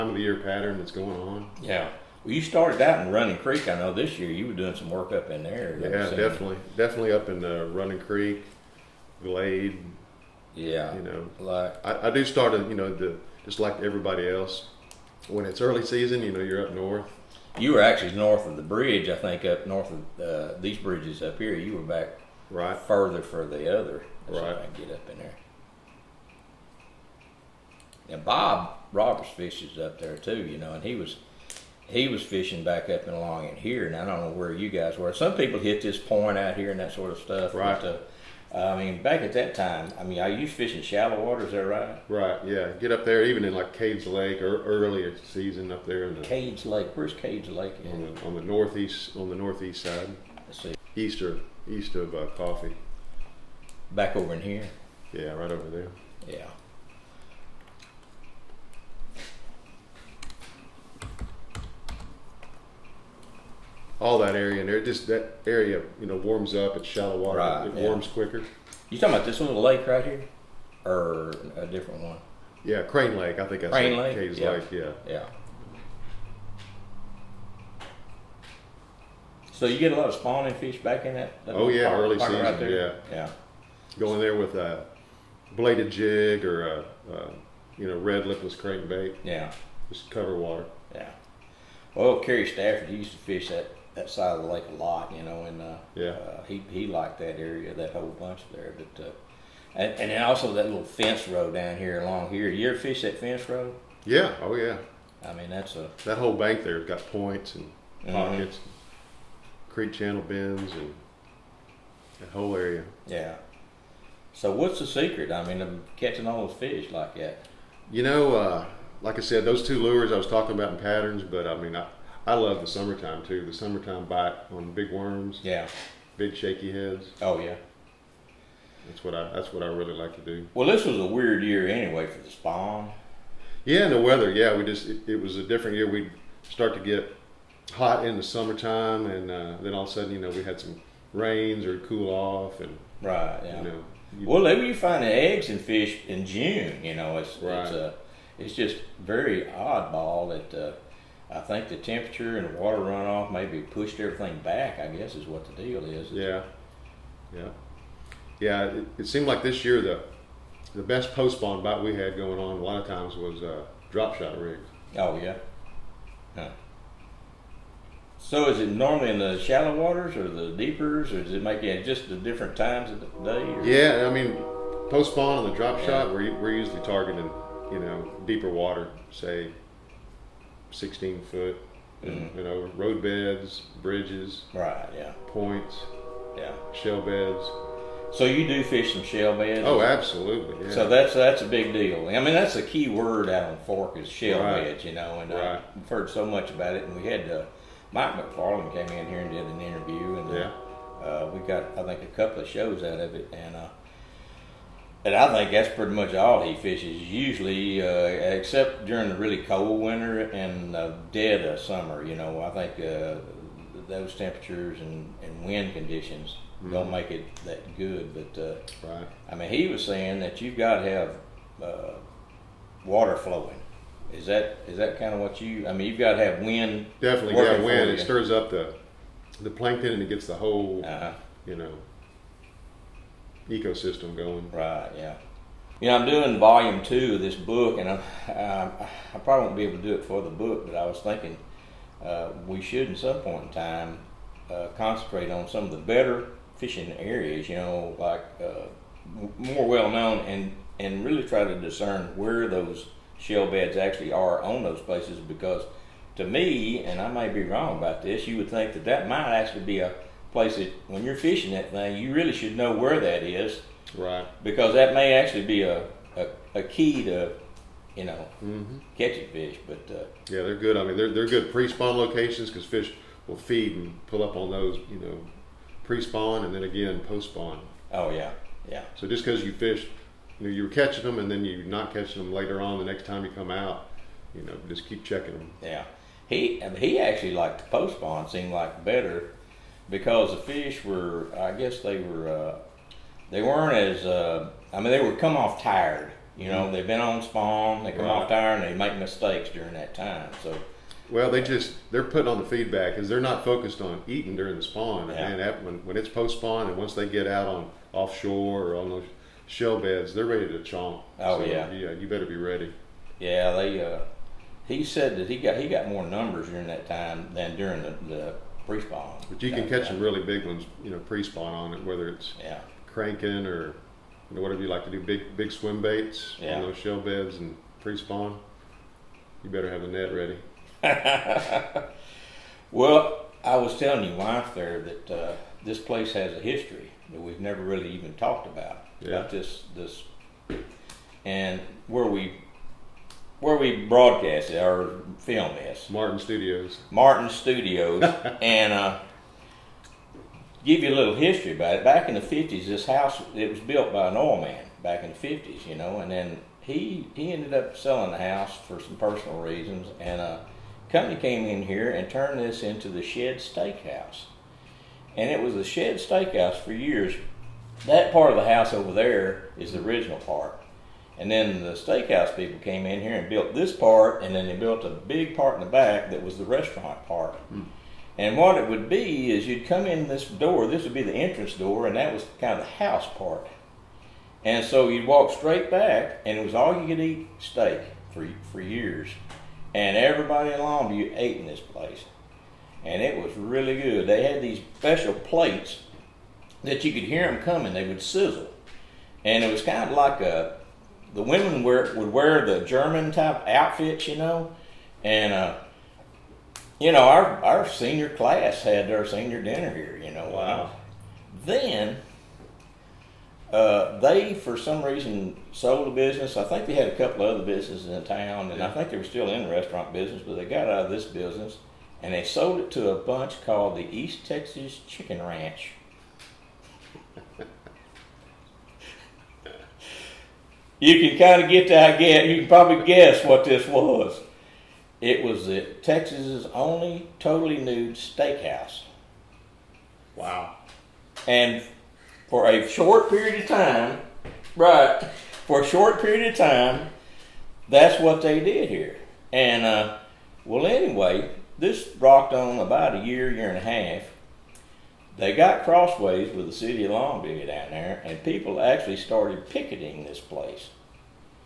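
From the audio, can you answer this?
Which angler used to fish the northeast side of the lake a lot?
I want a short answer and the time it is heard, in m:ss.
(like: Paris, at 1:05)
Kerry Stafford, at 1:32.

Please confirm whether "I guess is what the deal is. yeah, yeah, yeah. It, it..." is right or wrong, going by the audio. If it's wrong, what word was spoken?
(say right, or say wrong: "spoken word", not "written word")
right.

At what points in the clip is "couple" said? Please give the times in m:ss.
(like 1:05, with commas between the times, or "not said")
3:22, 6:56.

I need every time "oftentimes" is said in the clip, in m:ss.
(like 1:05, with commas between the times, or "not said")
not said.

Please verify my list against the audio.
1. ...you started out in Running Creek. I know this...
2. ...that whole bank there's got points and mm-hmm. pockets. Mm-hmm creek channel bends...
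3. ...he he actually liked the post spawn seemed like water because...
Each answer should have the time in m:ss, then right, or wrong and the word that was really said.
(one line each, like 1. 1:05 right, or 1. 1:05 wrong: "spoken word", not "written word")
1. 0:02 right
2. 1:46 right
3. 4:46 wrong: "better", not "water".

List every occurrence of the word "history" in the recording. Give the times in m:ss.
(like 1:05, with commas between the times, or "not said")
5:36, 5:51.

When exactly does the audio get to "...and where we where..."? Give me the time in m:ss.
5:41.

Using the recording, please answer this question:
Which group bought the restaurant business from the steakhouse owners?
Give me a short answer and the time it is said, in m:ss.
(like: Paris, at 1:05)
East Texas Chicken Ranch, at 7:03.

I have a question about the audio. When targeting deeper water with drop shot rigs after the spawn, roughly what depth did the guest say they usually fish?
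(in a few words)
16 feet.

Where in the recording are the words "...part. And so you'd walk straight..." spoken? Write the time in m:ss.
6:23.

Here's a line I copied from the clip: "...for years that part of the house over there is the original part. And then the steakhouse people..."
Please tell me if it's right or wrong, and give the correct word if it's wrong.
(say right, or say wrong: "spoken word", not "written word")
right.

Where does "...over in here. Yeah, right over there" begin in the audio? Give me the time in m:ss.
0:54.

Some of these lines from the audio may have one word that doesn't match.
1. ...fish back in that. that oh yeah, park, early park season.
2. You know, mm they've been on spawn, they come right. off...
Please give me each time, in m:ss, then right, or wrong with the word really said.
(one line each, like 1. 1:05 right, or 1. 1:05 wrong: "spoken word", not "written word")
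1. 1:20 right
2. 4:56 right.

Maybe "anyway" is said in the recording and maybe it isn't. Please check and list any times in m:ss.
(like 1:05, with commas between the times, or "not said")
2:11, 7:30.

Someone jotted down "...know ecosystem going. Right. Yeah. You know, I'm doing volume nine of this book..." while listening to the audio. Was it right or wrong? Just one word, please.
wrong.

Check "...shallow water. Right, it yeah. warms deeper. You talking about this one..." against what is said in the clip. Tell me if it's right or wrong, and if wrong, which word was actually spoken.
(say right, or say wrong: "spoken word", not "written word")
wrong: "quicker", not "deeper".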